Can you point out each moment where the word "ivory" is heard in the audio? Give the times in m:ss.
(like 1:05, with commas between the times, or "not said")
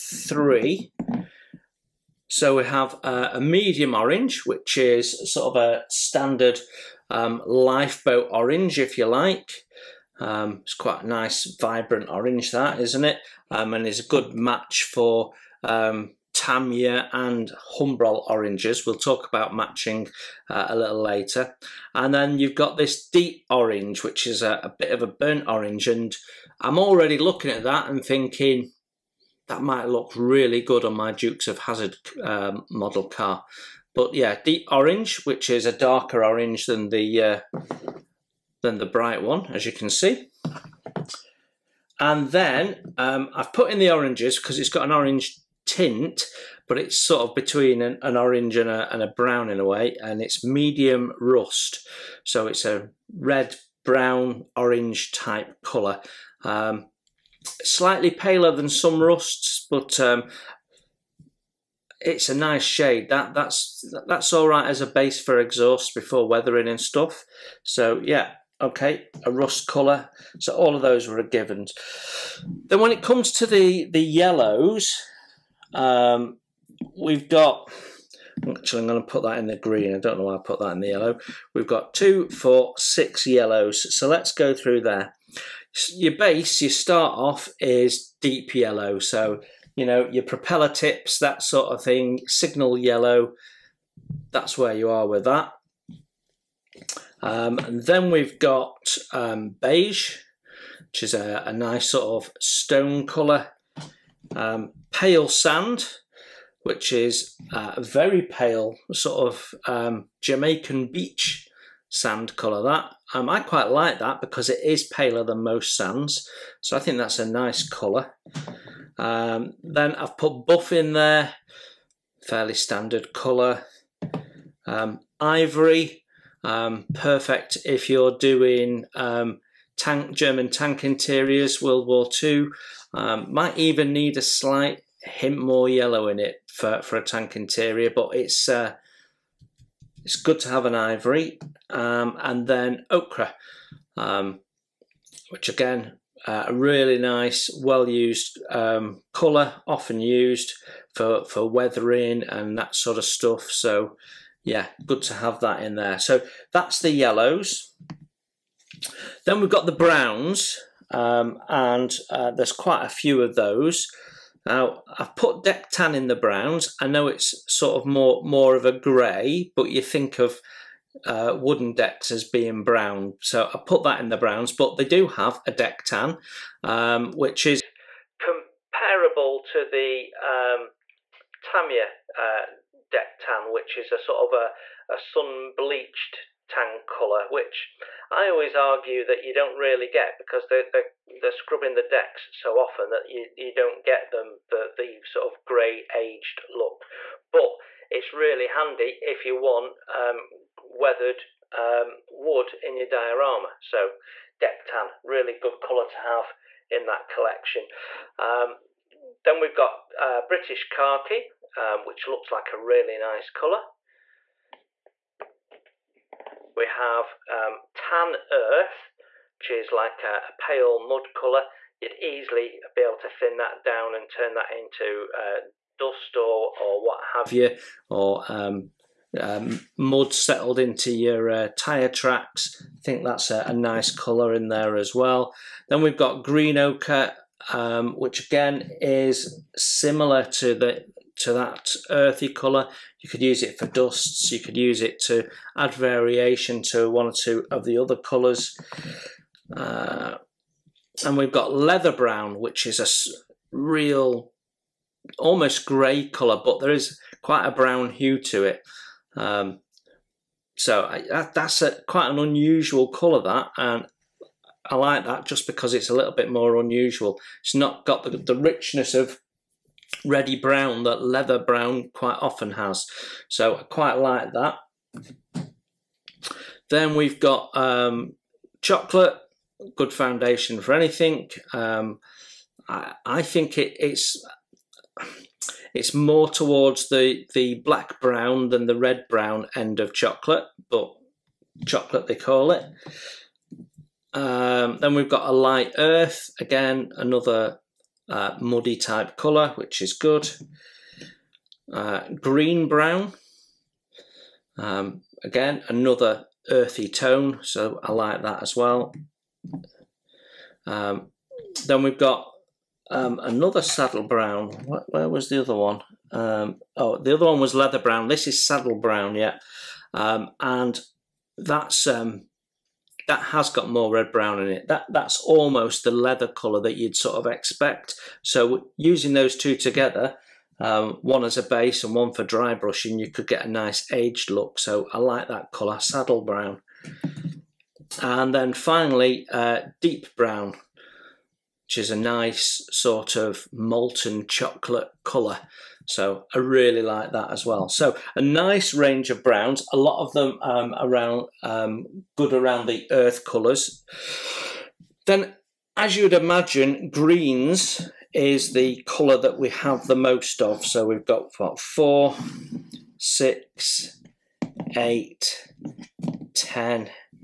2:05, 2:20.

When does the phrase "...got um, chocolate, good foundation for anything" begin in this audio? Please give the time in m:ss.
4:37.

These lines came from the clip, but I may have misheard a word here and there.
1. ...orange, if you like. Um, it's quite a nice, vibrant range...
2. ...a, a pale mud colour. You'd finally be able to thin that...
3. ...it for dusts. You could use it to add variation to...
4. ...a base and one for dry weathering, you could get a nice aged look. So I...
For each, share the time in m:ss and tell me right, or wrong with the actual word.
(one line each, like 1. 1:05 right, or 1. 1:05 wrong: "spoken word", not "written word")
1. 0:08 wrong: "orange", not "range"
2. 3:40 wrong: "easily", not "finally"
3. 4:03 right
4. 5:31 wrong: "brushing", not "weathering".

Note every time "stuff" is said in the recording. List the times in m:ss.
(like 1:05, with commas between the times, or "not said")
1:06, 2:33.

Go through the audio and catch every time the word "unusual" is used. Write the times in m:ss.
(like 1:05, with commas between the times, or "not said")
4:22, 4:26.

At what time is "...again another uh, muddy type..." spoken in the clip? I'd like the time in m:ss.
4:56.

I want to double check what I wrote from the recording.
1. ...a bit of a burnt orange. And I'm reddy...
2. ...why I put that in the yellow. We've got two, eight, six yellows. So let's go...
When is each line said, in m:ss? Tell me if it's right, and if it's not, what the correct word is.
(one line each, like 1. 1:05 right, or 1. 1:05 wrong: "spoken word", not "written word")
1. 0:24 wrong: "already", not "reddy"
2. 1:20 wrong: "four", not "eight".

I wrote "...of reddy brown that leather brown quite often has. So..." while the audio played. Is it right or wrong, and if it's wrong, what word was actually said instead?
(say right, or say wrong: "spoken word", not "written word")
right.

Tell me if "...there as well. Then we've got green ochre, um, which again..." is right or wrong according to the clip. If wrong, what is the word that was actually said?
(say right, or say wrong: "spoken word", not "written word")
right.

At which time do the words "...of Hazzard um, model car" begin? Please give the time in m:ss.
0:31.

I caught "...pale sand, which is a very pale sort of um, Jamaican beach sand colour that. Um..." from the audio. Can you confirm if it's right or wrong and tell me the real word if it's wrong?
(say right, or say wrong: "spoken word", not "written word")
right.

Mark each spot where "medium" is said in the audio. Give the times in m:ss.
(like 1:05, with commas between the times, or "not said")
0:03, 0:50.